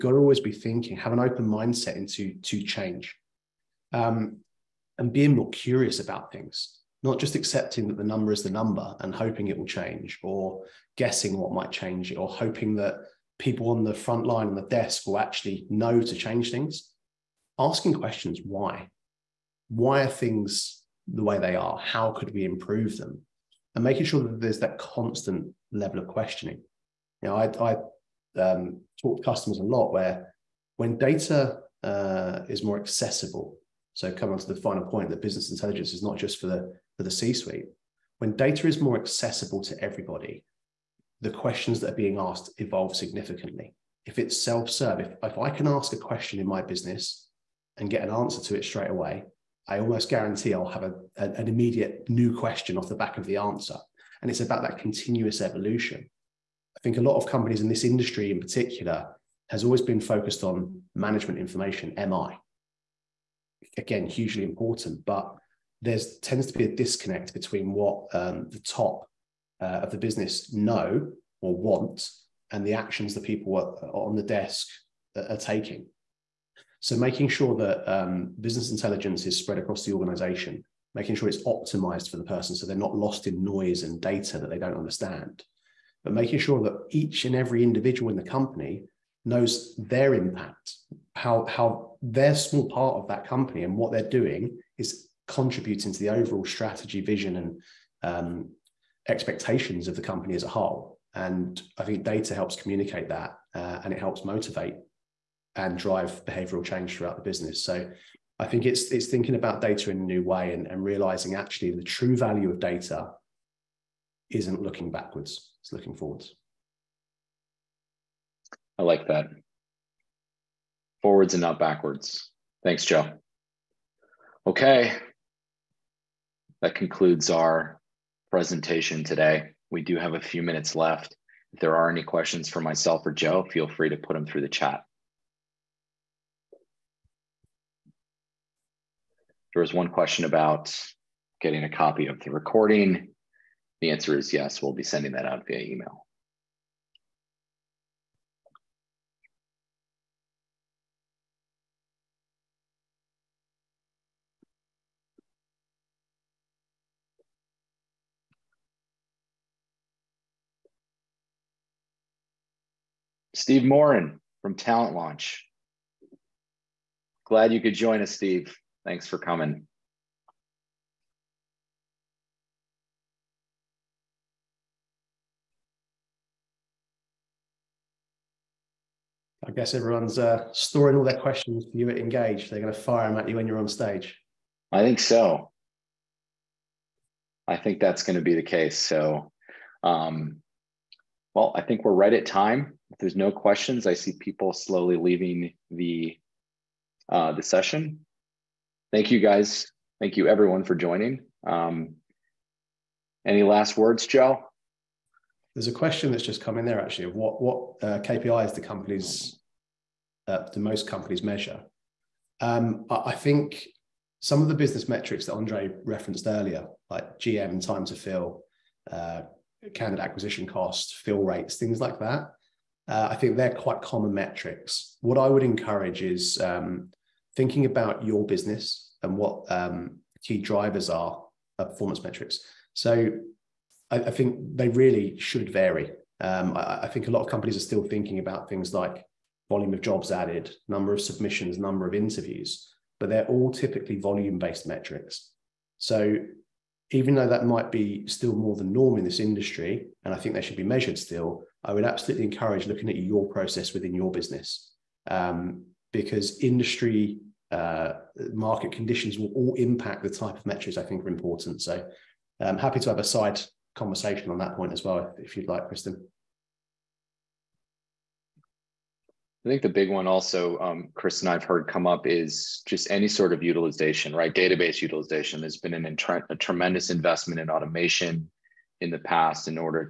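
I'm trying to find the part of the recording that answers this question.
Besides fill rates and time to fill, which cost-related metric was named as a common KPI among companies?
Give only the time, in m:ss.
3:39.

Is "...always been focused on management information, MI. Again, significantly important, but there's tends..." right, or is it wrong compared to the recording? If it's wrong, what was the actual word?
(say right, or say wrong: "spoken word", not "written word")
wrong: "hugely", not "significantly".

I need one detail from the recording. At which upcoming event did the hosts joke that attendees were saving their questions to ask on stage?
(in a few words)
Engage.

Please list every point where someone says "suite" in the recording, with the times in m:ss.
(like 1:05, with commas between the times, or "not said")
0:37.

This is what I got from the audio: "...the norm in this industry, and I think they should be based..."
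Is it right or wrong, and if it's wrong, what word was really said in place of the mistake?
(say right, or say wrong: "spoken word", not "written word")
wrong: "measured", not "based".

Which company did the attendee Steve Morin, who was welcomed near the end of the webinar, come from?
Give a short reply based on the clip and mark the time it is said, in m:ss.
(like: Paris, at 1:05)
Talent Launch, at 2:44.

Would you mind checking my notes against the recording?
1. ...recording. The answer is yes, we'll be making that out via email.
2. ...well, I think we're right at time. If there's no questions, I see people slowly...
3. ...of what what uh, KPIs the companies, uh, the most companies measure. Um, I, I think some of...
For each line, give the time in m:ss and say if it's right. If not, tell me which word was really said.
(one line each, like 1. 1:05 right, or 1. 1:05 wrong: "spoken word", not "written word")
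1. 2:22 wrong: "sending", not "making"
2. 3:11 right
3. 3:27 right.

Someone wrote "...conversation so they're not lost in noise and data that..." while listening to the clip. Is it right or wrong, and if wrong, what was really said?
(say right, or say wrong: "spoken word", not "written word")
wrong: "person", not "conversation".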